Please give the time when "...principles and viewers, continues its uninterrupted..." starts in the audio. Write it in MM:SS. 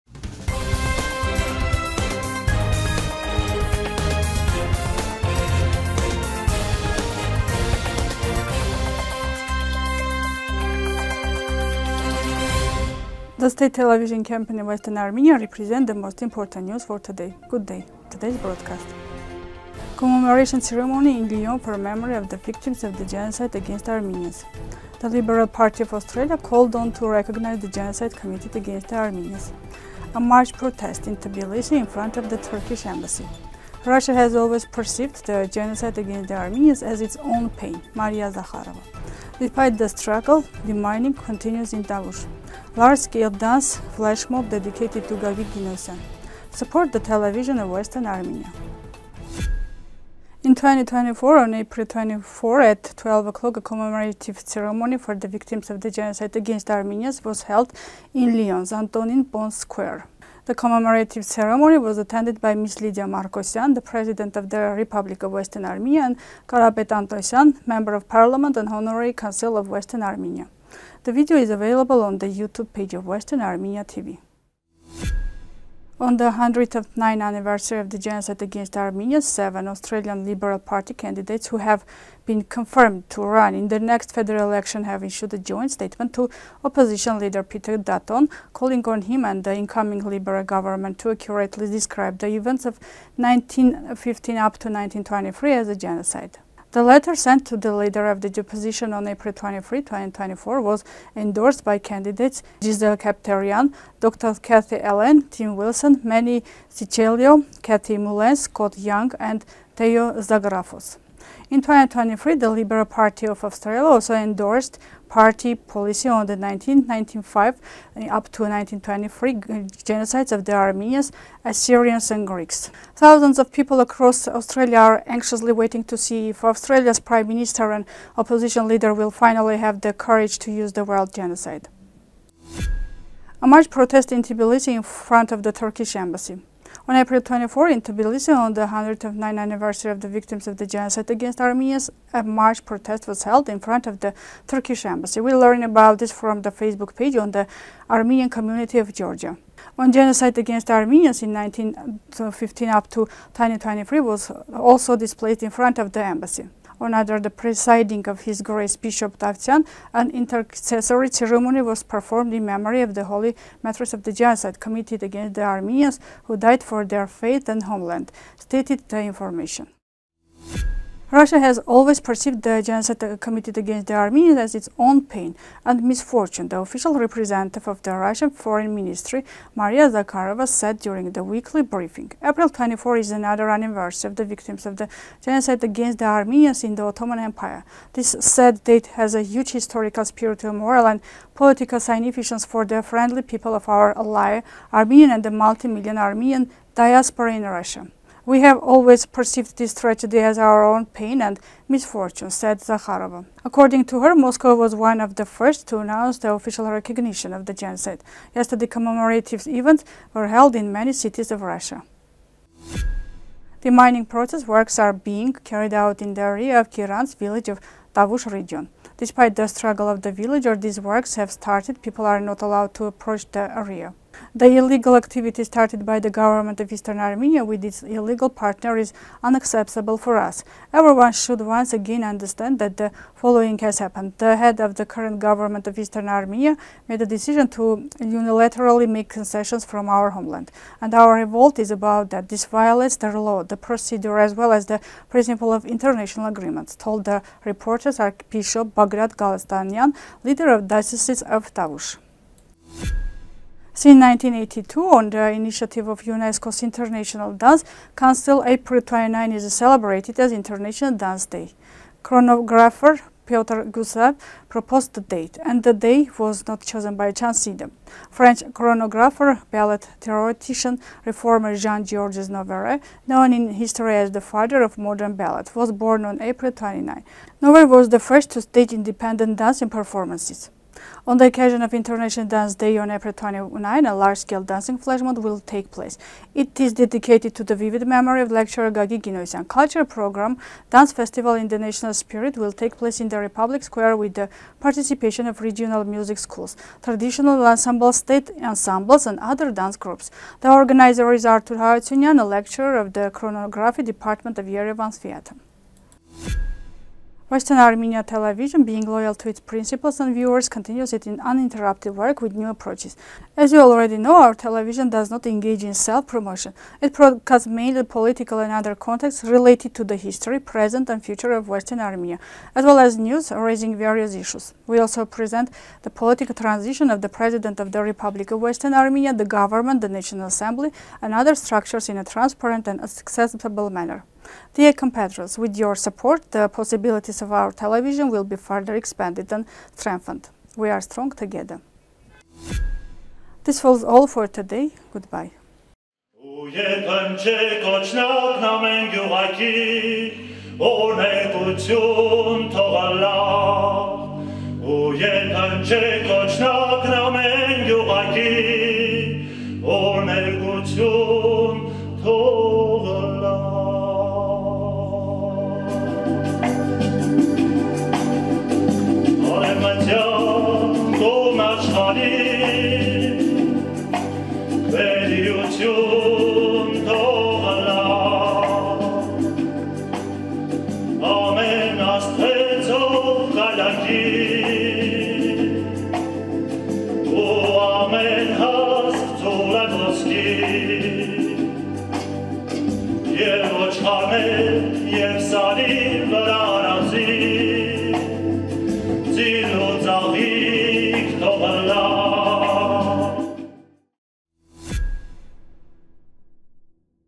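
05:09.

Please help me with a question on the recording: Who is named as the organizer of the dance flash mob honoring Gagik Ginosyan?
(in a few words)
Artur Haratsunyan.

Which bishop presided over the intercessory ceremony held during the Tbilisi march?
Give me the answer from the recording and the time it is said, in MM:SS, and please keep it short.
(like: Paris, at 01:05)
Bishop Davtian, at 02:38.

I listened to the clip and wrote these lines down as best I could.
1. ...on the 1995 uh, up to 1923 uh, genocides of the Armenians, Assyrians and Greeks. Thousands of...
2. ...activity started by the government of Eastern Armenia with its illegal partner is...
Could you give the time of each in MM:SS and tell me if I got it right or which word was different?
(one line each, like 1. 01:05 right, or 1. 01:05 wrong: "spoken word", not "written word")
1. 01:56 right
2. 03:44 right.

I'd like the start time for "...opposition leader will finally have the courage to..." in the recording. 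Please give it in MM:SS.
02:08.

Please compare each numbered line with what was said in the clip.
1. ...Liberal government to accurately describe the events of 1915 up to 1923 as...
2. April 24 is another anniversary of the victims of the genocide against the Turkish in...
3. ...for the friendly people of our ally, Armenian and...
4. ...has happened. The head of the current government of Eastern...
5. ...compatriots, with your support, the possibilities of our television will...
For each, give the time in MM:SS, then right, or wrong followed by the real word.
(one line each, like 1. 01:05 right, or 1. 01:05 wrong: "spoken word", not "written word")
1. 01:30 right
2. 03:02 wrong: "Armenians", not "Turkish"
3. 03:12 right
4. 03:53 right
5. 05:34 right.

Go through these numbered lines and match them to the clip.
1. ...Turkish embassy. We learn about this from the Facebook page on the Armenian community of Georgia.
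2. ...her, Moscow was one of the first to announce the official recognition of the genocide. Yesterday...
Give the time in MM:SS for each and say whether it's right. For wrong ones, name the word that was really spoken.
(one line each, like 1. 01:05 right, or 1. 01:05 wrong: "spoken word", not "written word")
1. 02:24 right
2. 03:24 right.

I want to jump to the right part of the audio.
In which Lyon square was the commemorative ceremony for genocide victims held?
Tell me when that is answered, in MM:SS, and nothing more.
00:58.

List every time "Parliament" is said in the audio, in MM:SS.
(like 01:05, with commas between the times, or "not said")
01:08.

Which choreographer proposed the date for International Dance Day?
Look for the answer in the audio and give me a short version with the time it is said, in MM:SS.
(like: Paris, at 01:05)
Piotr Gusev, at 04:23.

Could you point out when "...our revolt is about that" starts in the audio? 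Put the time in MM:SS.
04:00.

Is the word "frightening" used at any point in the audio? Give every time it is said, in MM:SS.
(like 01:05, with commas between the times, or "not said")
not said.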